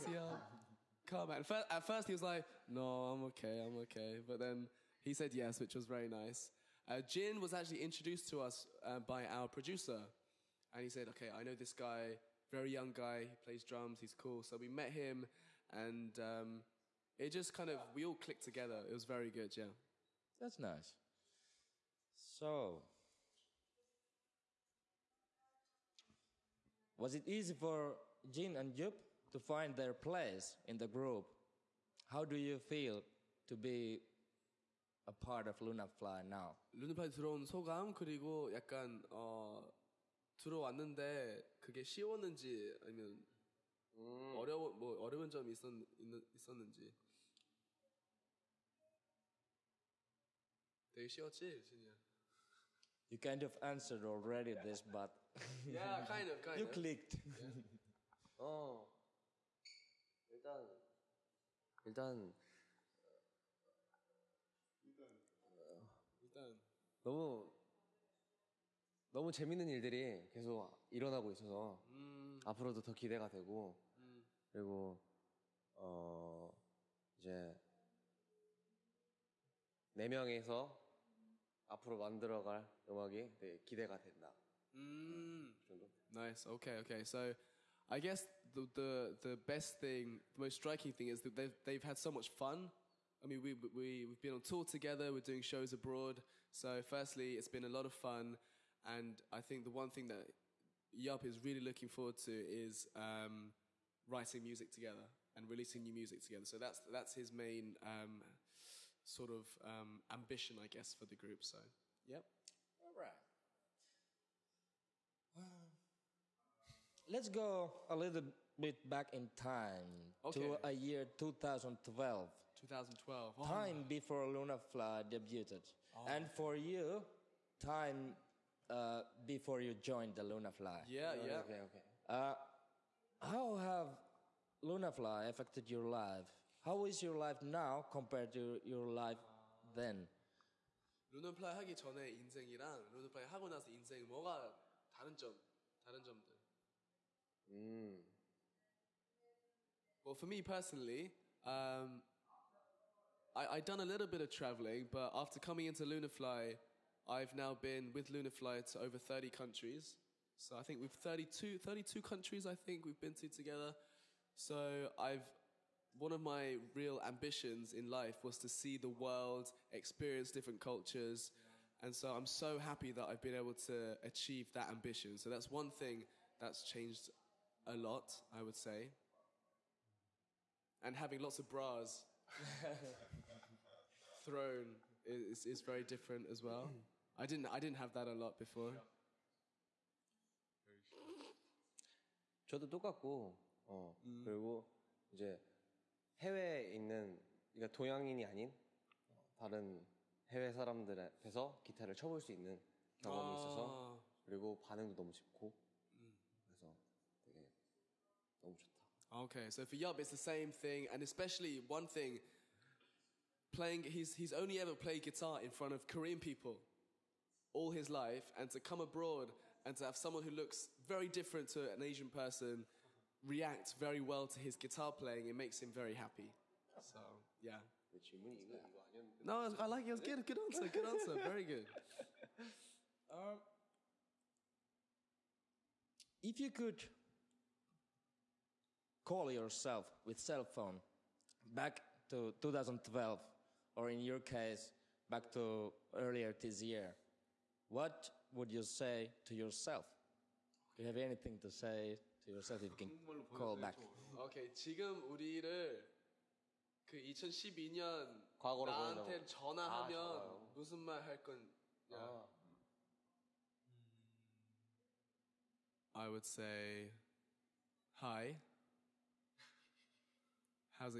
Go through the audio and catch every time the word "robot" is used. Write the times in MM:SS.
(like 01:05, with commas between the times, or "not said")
not said.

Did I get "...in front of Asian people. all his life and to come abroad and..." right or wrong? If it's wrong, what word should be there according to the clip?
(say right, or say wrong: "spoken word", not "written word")
wrong: "Korean", not "Asian".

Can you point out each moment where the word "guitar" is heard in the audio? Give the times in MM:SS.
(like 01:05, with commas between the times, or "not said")
03:35, 03:44.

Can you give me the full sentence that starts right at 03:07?
I didn't I didn't have that a lot before.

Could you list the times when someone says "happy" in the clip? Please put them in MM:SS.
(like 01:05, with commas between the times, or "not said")
02:52, 03:45.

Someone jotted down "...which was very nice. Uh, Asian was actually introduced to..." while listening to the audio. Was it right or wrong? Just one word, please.
wrong.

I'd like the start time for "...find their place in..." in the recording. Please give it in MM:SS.
00:29.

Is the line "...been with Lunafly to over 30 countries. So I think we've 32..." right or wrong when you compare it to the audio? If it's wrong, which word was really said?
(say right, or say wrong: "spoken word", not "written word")
right.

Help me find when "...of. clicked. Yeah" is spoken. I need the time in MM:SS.
00:56.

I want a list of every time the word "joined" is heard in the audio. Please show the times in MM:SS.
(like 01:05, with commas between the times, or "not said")
02:09.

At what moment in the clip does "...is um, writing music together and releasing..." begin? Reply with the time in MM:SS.
01:42.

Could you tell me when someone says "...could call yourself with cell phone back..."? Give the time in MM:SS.
03:56.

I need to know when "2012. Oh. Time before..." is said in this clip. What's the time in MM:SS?
02:02.